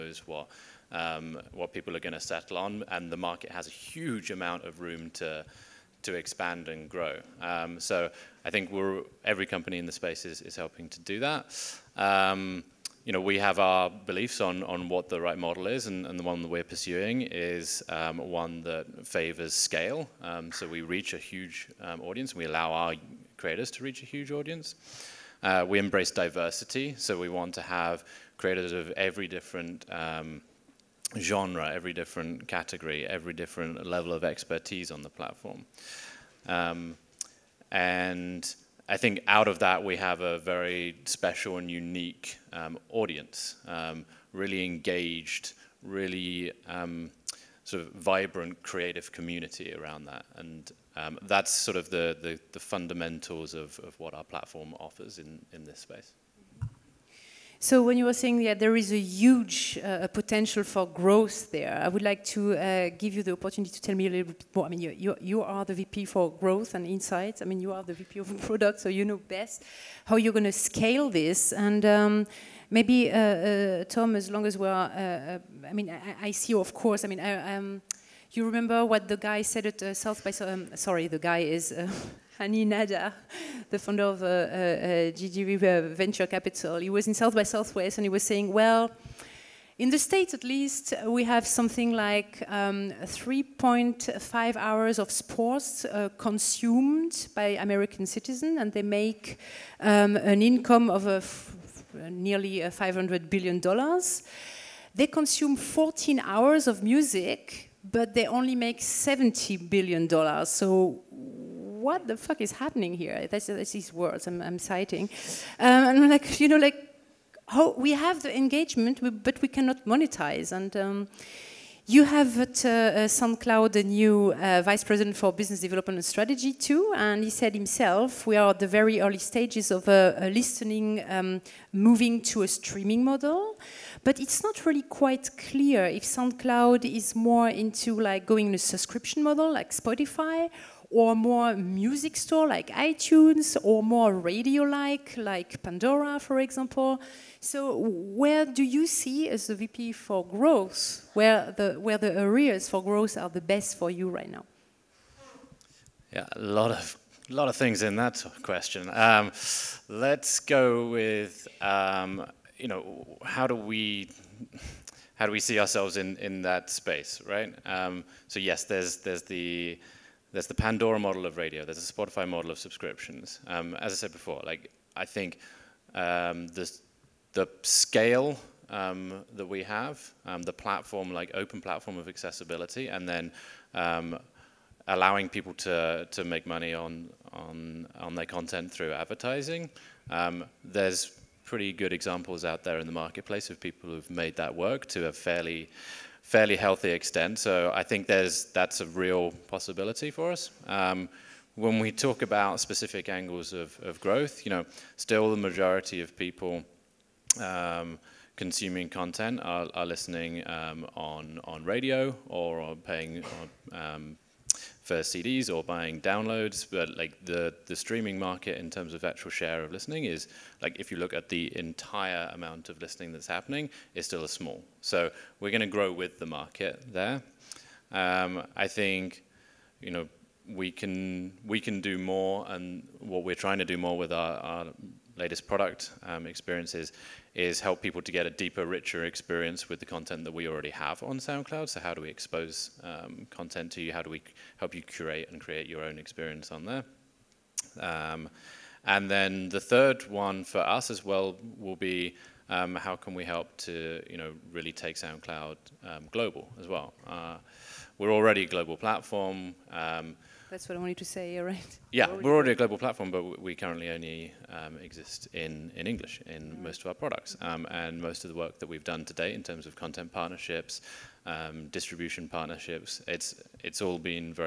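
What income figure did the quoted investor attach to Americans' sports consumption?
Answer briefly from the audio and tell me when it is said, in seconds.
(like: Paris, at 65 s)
$500 billion, at 102 s.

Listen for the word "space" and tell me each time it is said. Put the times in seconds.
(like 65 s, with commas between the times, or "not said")
9 s, 55 s, 166 s.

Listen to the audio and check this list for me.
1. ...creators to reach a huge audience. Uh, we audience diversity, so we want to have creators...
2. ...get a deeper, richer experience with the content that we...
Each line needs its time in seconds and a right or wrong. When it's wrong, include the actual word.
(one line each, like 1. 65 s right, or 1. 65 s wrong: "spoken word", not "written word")
1. 23 s wrong: "embrace", not "audience"
2. 238 s right.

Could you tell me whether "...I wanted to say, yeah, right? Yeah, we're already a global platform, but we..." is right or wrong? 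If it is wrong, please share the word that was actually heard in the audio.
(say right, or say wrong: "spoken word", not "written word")
right.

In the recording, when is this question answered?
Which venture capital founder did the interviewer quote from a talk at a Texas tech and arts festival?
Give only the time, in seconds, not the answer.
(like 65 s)
82 s.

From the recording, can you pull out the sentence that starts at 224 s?
So we're going to grow with the market there.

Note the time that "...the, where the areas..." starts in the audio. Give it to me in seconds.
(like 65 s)
151 s.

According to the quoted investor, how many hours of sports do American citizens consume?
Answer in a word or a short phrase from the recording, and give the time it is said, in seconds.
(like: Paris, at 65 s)
3.5 hours, at 93 s.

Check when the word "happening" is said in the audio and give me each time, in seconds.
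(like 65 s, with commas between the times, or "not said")
112 s, 223 s.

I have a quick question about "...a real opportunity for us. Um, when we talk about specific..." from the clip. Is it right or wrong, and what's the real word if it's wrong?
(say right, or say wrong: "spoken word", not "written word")
wrong: "possibility", not "opportunity".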